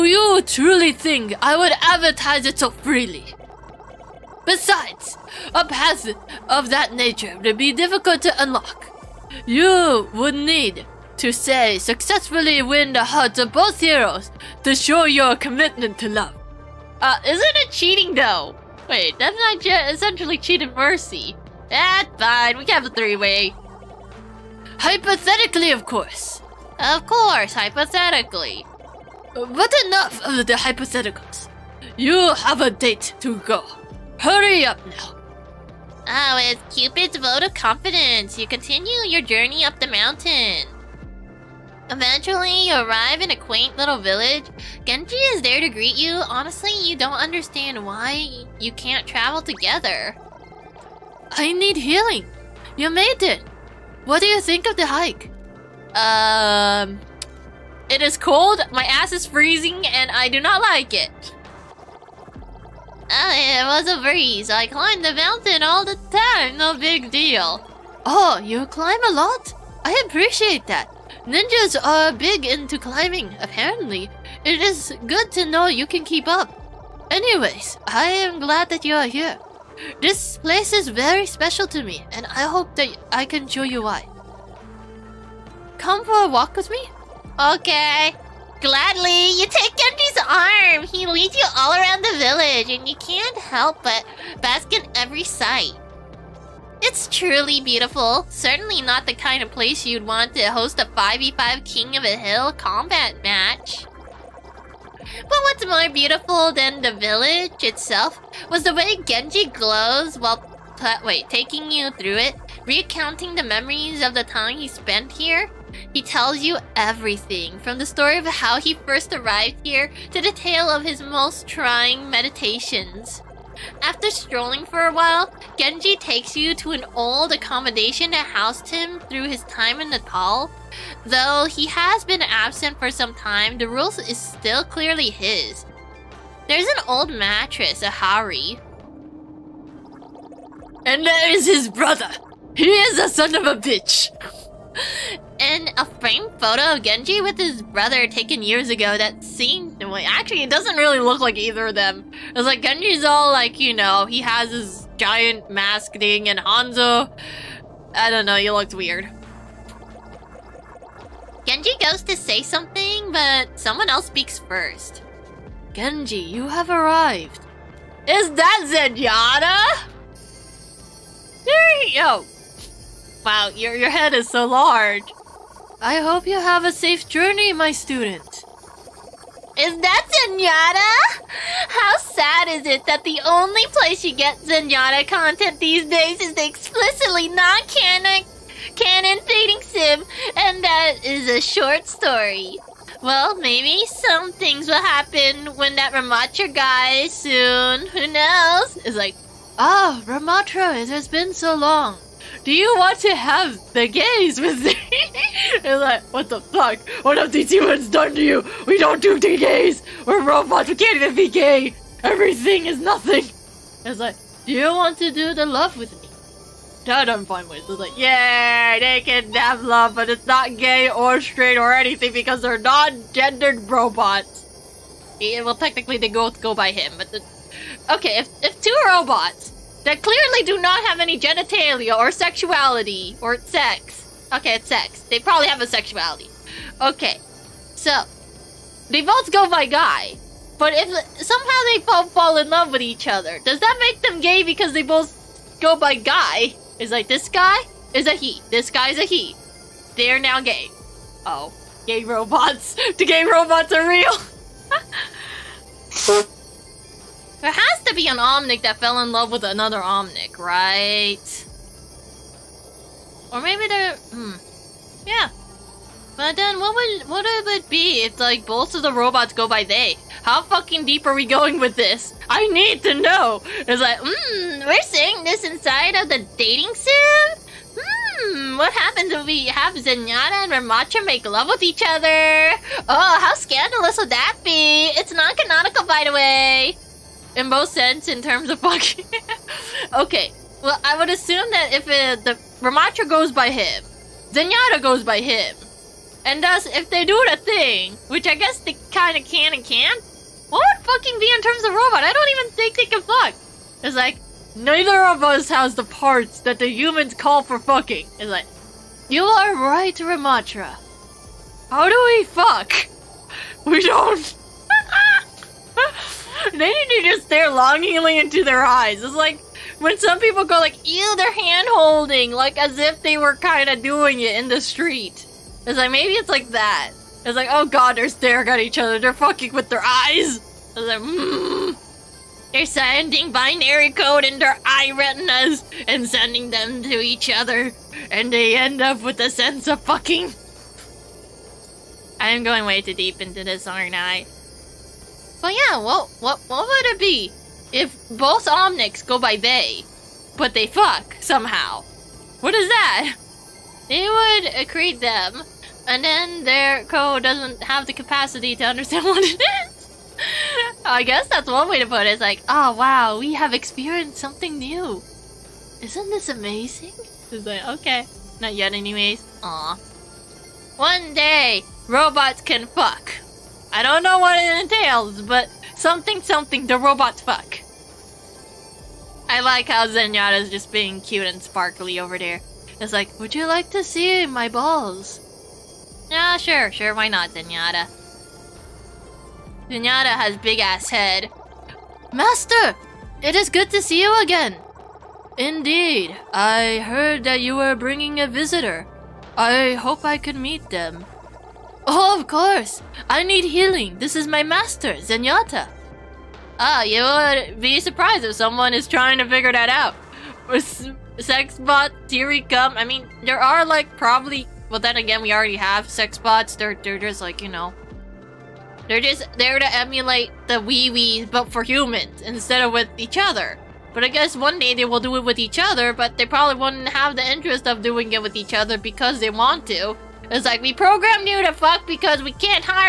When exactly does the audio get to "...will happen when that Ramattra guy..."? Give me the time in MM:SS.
03:14.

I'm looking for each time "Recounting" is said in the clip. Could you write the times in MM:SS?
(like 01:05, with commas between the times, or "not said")
01:52.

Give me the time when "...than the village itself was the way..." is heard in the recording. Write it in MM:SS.
01:46.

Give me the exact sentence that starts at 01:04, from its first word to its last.
I climb the mountain all the time.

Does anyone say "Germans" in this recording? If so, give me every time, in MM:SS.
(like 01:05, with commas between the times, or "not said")
not said.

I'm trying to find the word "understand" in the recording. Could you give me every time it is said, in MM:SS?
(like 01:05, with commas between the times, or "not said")
00:47, 05:58.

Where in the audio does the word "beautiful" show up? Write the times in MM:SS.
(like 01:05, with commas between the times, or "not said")
01:37, 01:45.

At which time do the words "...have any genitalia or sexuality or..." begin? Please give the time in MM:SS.
03:50.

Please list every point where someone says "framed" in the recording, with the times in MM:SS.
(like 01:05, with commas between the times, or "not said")
02:26.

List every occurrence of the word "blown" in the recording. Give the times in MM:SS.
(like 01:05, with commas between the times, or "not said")
not said.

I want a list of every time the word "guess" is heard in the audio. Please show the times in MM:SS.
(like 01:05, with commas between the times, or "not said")
04:58, 06:01, 07:04.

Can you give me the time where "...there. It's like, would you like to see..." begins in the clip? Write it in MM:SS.
06:22.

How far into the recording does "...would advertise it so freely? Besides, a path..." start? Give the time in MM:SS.
00:01.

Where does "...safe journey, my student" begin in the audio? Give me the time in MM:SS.
02:56.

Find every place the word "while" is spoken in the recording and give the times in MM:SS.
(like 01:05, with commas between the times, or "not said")
01:50, 02:04.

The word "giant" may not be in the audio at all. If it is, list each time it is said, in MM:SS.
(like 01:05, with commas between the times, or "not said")
02:34.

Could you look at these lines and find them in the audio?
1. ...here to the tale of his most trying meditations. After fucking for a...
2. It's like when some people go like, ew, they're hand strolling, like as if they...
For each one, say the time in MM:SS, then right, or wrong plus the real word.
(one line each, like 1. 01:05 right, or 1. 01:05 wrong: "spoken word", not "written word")
1. 01:59 wrong: "strolling", not "fucking"
2. 05:19 wrong: "holding", not "strolling".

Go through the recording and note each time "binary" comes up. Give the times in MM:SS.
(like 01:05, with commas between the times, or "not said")
05:33.